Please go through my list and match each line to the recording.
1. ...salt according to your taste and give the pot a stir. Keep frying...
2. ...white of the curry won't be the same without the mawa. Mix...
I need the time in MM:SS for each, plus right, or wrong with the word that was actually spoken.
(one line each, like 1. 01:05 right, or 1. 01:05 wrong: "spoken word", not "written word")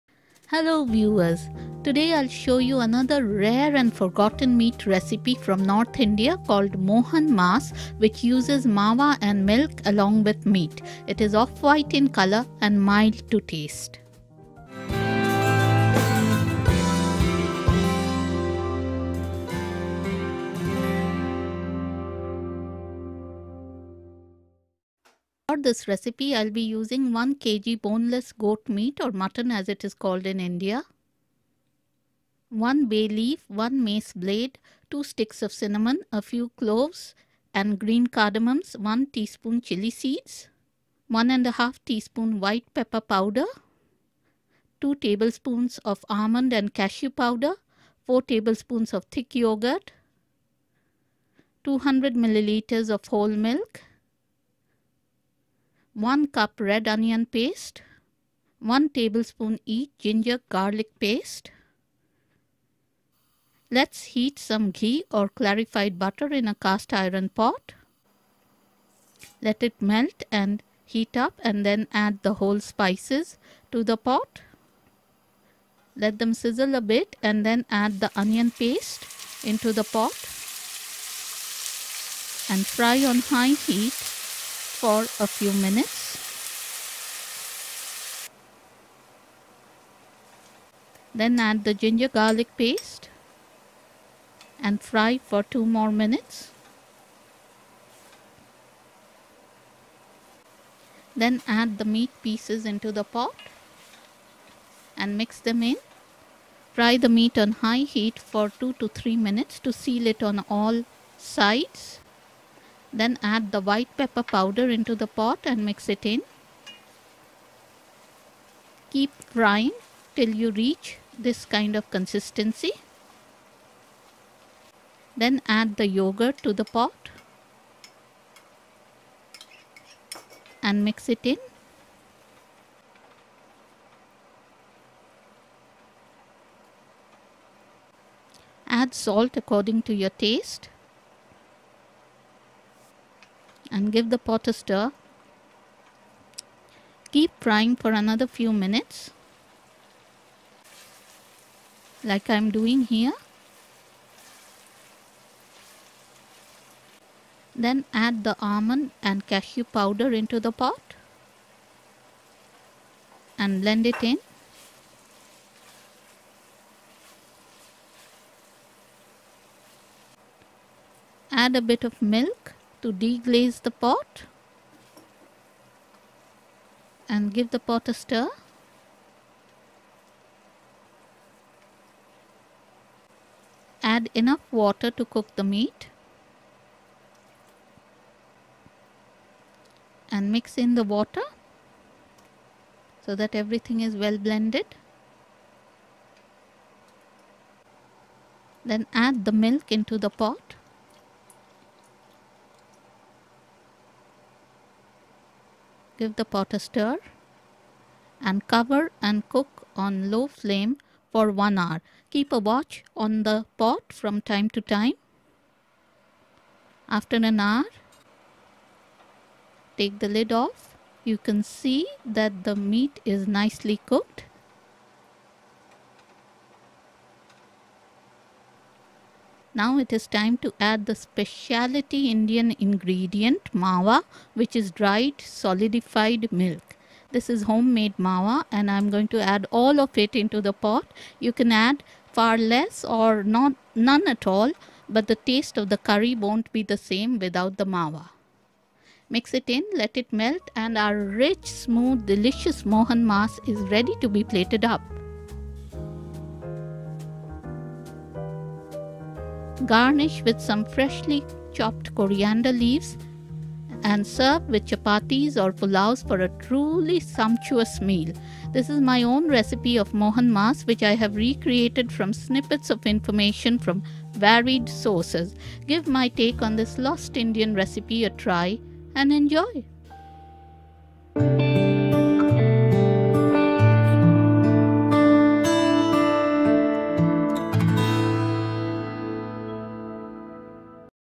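1. 02:18 right
2. 04:05 wrong: "taste", not "white".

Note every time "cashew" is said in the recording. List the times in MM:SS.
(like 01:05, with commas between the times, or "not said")
00:46, 02:39.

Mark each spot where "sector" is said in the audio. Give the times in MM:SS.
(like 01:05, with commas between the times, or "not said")
not said.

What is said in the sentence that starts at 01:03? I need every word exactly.
Let's heat some ghee or clarified butter in a cast iron pot.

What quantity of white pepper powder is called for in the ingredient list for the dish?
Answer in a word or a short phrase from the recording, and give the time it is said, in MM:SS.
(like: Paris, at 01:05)
1.5 teaspoons, at 00:41.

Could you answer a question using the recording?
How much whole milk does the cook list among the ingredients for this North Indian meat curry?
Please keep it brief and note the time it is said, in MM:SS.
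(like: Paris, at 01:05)
200 milliliters, at 00:51.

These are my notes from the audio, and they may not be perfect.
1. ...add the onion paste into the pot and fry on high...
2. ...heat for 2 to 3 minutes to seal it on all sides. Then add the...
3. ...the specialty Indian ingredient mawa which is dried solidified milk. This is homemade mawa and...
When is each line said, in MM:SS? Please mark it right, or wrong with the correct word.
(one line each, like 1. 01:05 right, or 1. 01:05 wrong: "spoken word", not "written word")
1. 01:17 right
2. 01:47 right
3. 03:50 right.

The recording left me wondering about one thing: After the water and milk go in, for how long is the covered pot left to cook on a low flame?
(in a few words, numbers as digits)
1 hour.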